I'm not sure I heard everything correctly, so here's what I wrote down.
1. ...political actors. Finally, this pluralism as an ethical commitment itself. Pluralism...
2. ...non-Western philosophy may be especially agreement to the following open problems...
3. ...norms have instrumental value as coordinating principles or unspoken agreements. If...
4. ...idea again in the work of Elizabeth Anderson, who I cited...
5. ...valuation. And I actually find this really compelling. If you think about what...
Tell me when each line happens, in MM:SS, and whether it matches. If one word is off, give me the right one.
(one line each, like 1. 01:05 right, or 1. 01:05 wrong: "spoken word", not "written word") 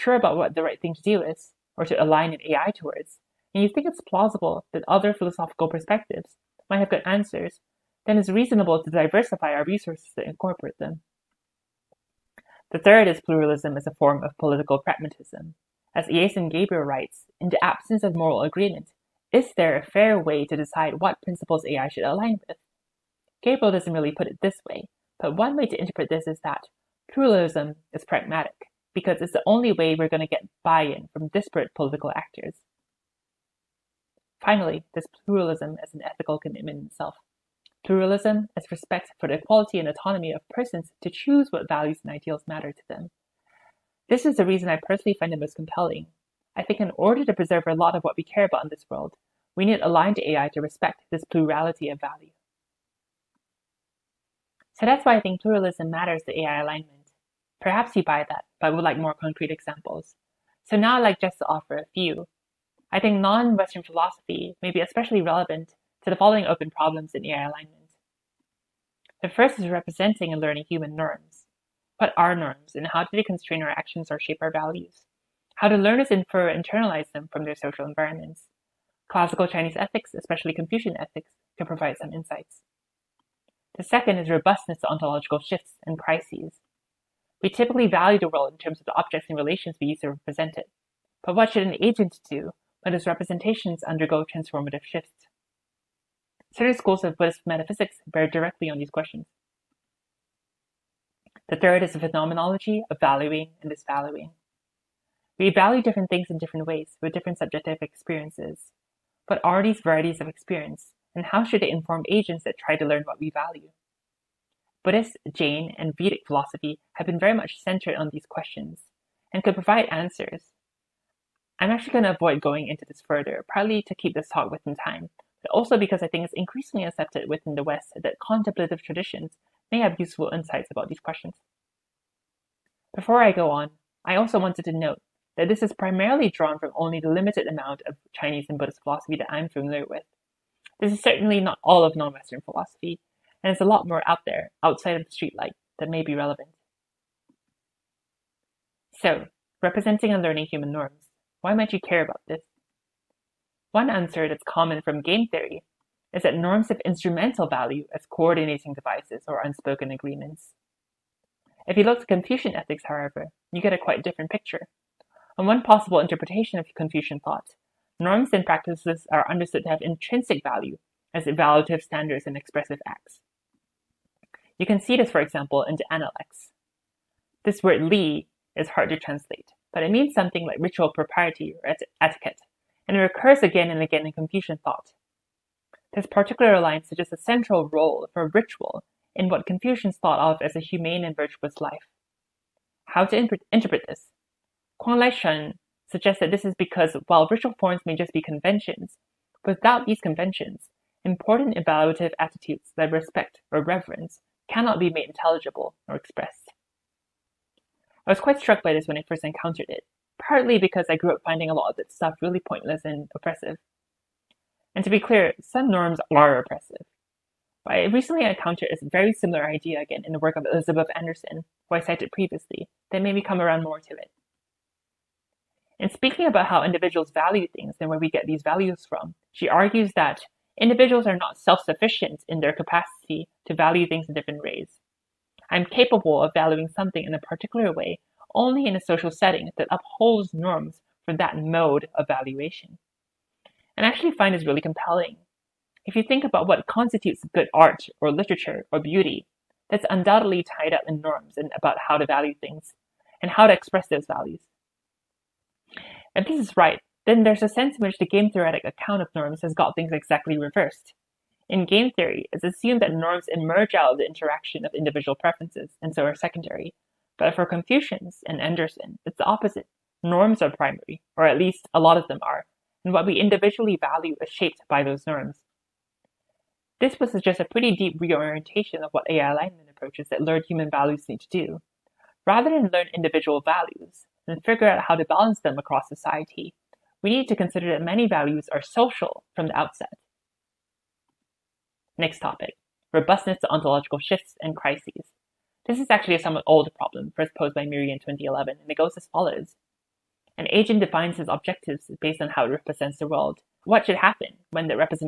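1. 00:31 right
2. 01:03 wrong: "relevant", not "agreement"
3. 02:36 wrong: "devices", not "principles"
4. 03:39 right
5. 04:02 right.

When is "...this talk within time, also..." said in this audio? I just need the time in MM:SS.
02:04.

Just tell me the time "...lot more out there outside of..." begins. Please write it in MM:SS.
02:23.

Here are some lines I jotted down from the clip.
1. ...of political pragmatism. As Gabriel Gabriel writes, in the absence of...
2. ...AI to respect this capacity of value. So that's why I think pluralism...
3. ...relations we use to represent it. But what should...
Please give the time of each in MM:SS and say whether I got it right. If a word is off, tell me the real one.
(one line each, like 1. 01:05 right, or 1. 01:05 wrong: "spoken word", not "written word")
1. 00:14 wrong: "Iason", not "Gabriel"
2. 00:50 wrong: "plurality", not "capacity"
3. 01:29 right.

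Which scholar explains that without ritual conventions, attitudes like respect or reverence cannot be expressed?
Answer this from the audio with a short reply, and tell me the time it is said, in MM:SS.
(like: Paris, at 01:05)
Kwong-loi Shun, at 03:14.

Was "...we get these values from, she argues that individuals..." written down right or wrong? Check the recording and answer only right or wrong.
right.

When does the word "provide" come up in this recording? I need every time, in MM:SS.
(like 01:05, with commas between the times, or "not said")
01:21, 01:59.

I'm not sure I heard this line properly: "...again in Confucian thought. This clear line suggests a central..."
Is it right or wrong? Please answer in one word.
wrong.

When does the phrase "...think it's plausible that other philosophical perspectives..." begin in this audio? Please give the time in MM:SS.
00:03.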